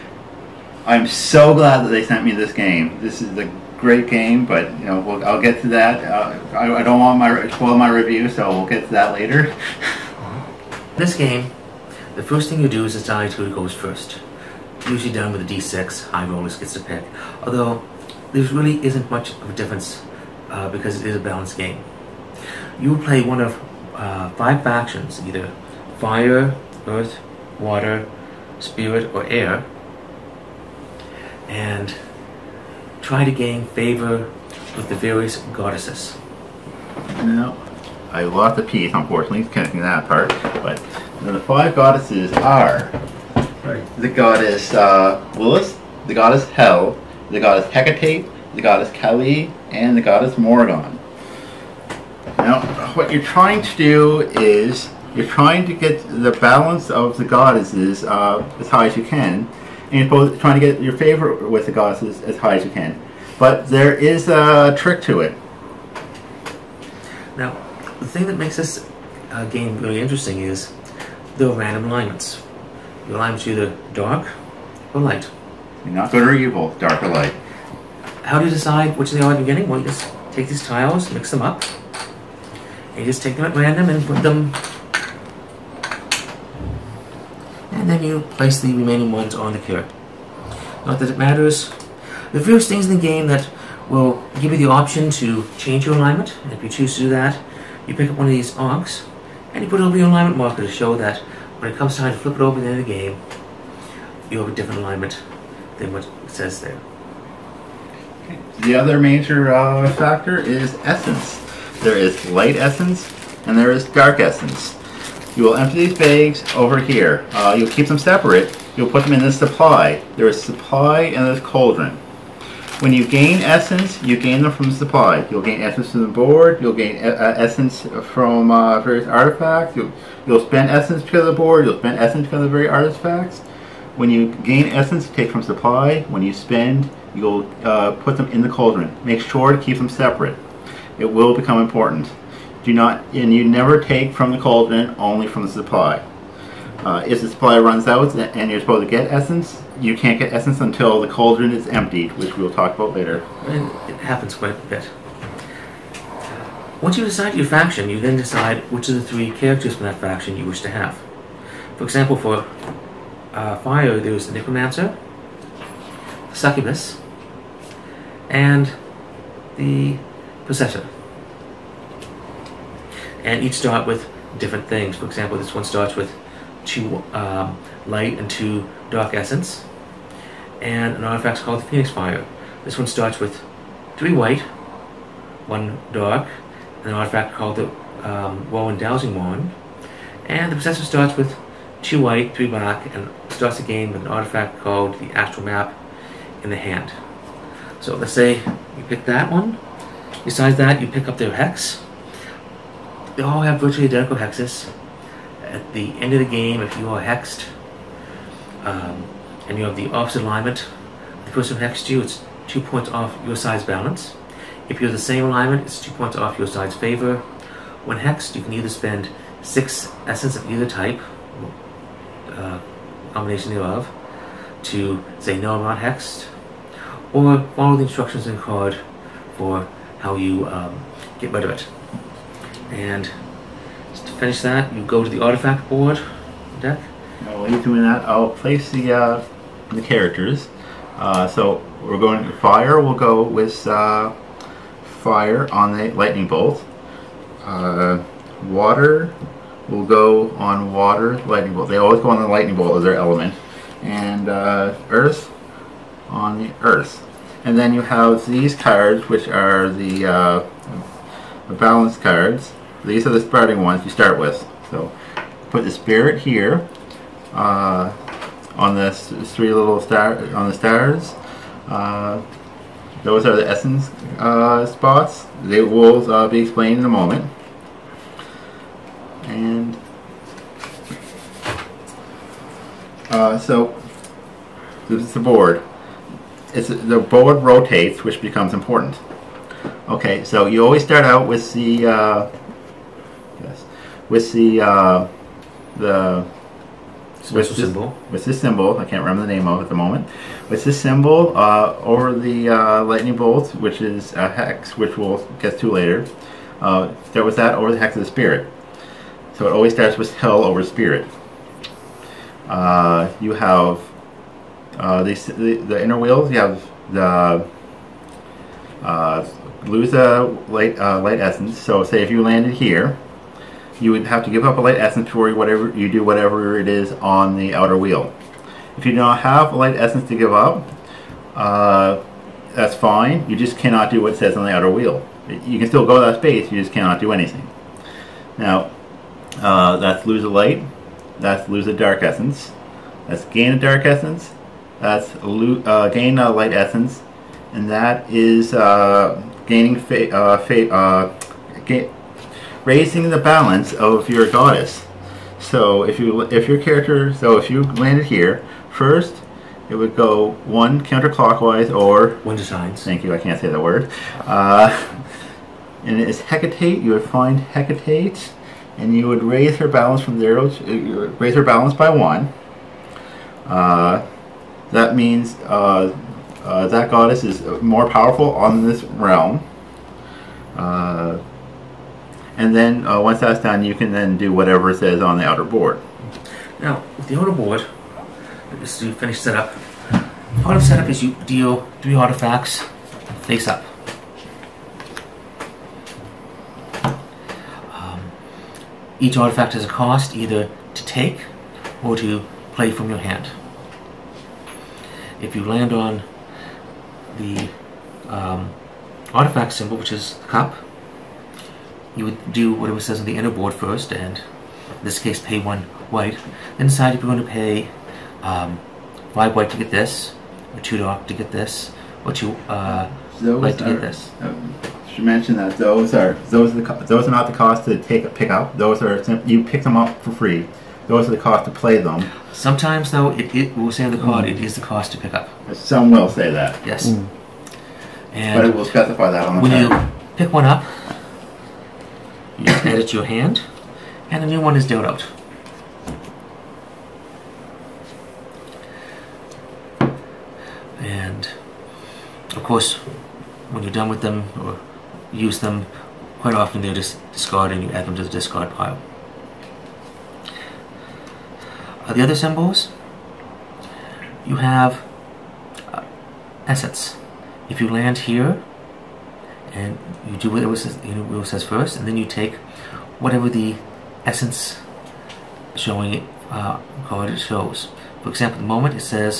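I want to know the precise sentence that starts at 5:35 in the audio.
You can still go that space, you just cannot do anything.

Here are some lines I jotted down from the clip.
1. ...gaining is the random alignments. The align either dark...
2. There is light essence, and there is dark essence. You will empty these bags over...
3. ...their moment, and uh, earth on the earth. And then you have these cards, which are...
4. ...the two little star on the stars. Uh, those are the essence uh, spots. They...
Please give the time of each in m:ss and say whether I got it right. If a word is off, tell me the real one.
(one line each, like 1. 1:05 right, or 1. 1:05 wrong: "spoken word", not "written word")
1. 1:09 wrong: "interesting", not "gaining"
2. 1:51 right
3. 4:12 wrong: "element", not "moment"
4. 4:28 wrong: "three", not "two".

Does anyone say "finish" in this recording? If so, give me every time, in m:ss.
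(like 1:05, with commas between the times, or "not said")
3:54, 6:28.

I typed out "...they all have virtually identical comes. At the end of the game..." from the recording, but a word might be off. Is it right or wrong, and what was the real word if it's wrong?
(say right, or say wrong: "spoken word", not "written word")
wrong: "hexes", not "comes".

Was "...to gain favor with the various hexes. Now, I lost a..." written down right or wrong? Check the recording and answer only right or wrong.
wrong.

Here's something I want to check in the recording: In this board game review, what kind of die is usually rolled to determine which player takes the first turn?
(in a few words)
D6.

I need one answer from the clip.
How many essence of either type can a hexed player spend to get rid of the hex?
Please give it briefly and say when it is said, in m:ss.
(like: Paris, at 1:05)
6, at 3:39.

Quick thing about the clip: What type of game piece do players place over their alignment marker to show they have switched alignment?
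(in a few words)
onks.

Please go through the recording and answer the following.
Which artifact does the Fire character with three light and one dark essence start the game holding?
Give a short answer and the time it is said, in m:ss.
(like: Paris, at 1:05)
Dowsing Wand, at 3:08.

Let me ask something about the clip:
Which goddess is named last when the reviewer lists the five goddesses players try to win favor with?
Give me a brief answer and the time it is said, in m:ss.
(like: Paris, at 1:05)
Morgon, at 0:50.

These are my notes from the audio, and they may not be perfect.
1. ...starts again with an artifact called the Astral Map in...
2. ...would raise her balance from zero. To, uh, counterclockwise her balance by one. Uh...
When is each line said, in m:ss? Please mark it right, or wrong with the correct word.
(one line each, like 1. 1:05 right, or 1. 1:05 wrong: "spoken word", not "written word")
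1. 3:13 right
2. 6:09 wrong: "raise", not "counterclockwise".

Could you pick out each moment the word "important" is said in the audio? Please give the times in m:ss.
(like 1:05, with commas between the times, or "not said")
2:21, 4:48.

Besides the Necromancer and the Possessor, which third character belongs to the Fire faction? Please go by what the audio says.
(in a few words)
Succubus.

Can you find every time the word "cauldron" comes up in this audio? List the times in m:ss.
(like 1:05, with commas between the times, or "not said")
2:01, 2:18, 2:24, 2:31.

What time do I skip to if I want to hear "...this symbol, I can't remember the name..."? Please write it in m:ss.
4:58.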